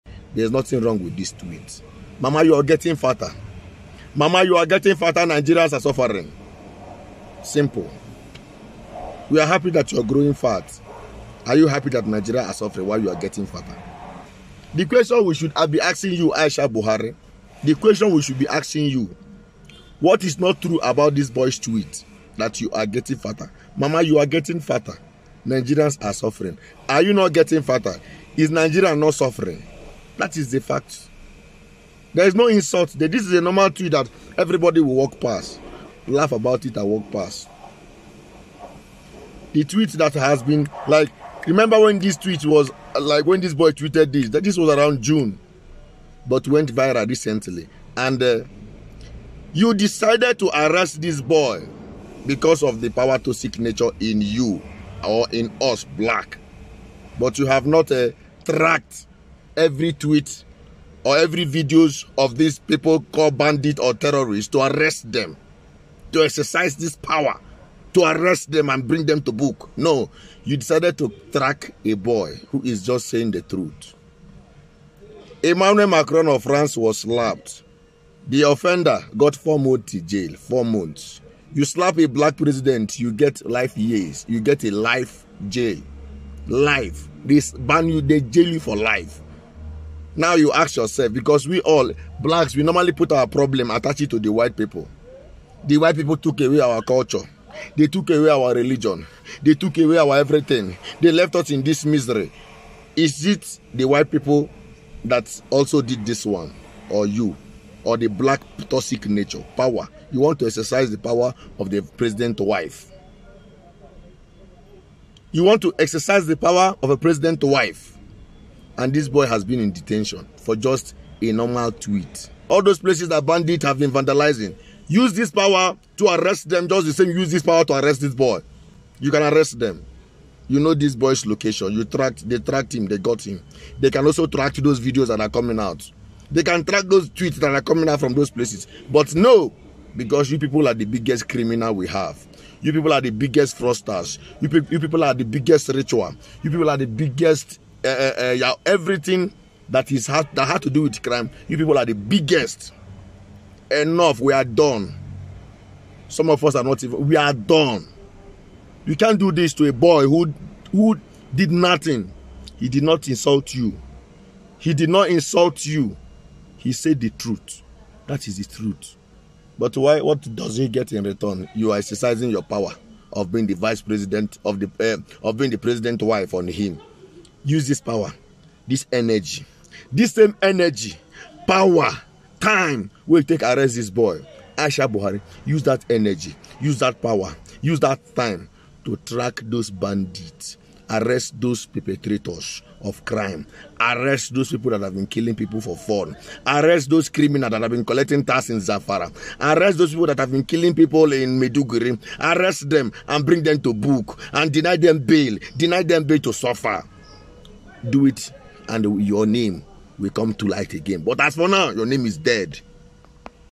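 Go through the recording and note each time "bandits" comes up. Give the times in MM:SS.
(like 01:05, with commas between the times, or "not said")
01:03, 02:03, 03:09.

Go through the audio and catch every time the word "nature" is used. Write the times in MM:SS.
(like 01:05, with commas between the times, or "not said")
00:53, 01:49.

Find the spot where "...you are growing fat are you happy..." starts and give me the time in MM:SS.
00:09.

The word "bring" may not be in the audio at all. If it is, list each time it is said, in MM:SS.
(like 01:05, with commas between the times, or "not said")
01:08, 03:23.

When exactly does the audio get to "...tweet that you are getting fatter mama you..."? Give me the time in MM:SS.
00:21.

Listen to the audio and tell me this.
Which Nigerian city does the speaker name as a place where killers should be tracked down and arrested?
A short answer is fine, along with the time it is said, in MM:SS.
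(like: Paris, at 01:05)
Maiduguri, at 03:21.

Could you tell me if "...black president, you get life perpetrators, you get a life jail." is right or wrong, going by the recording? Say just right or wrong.
wrong.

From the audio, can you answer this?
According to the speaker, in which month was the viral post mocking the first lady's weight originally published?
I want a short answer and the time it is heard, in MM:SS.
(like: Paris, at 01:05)
June, at 00:45.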